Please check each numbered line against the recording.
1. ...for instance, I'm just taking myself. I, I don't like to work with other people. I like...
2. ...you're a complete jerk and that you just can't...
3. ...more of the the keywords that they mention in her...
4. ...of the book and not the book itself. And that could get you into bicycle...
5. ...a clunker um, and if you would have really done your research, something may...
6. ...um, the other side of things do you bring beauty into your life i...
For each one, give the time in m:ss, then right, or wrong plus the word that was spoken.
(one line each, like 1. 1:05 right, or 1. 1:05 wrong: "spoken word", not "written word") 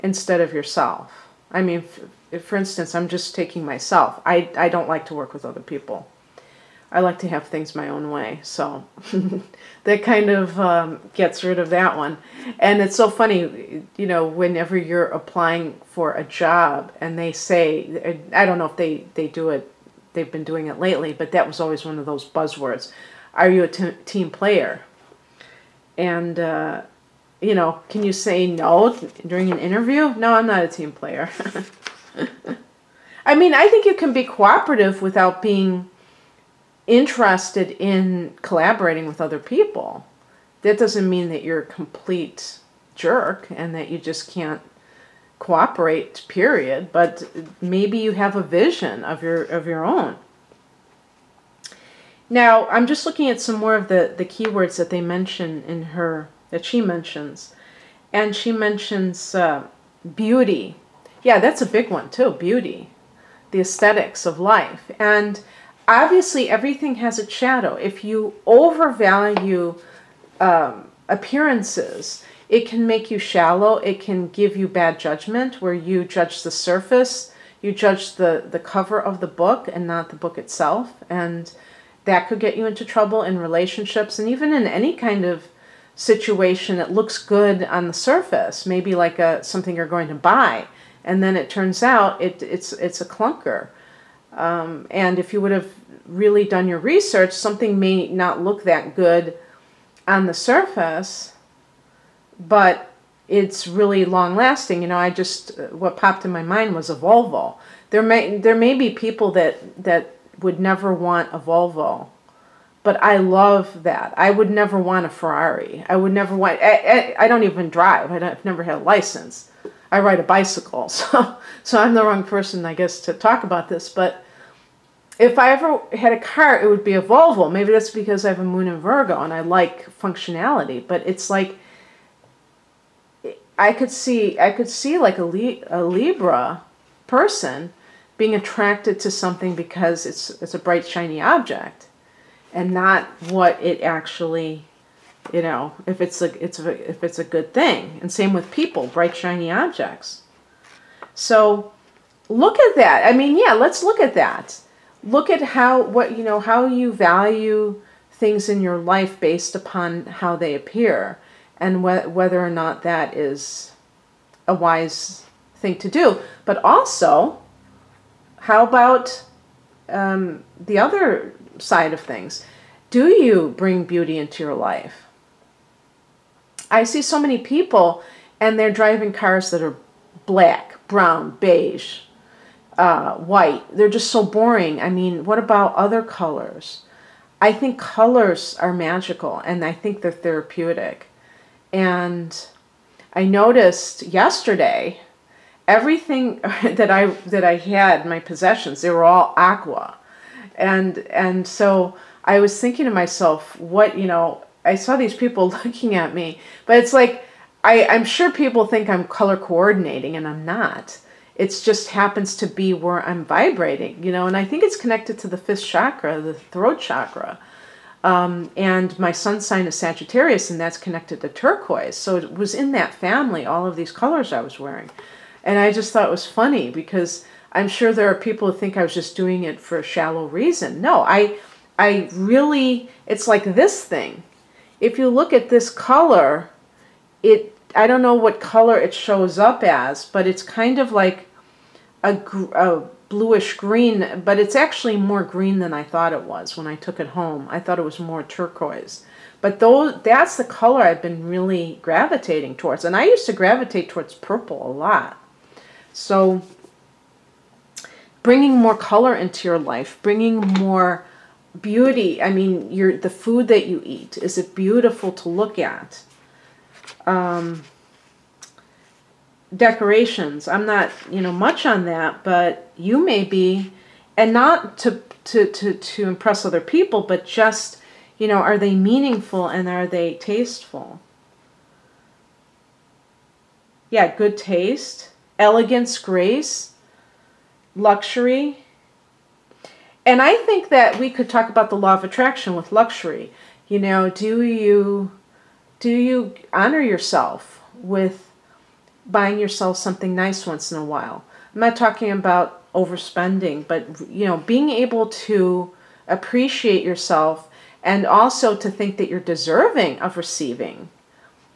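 1. 0:02 right
2. 0:41 right
3. 0:53 right
4. 1:19 wrong: "trouble", not "bicycle"
5. 1:32 right
6. 2:49 right.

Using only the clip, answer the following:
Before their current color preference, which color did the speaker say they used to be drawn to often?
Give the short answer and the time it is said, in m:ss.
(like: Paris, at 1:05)
purple, at 4:14.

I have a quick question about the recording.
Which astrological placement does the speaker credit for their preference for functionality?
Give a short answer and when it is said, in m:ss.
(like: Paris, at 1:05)
moon in Virgo, at 2:08.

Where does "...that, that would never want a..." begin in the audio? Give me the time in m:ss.
1:49.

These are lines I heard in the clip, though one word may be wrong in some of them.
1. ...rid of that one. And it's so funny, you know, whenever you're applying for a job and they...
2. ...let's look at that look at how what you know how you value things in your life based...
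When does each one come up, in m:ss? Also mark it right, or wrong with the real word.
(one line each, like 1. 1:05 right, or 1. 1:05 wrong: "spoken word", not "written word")
1. 0:11 right
2. 2:33 right.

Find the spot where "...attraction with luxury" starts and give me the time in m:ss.
4:52.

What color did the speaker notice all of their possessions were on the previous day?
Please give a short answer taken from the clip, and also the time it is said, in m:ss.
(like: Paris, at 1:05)
aqua, at 3:19.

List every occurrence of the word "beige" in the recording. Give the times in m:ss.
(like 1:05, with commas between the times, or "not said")
3:01.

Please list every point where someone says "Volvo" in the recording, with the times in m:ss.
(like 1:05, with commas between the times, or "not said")
1:46, 1:51, 2:07.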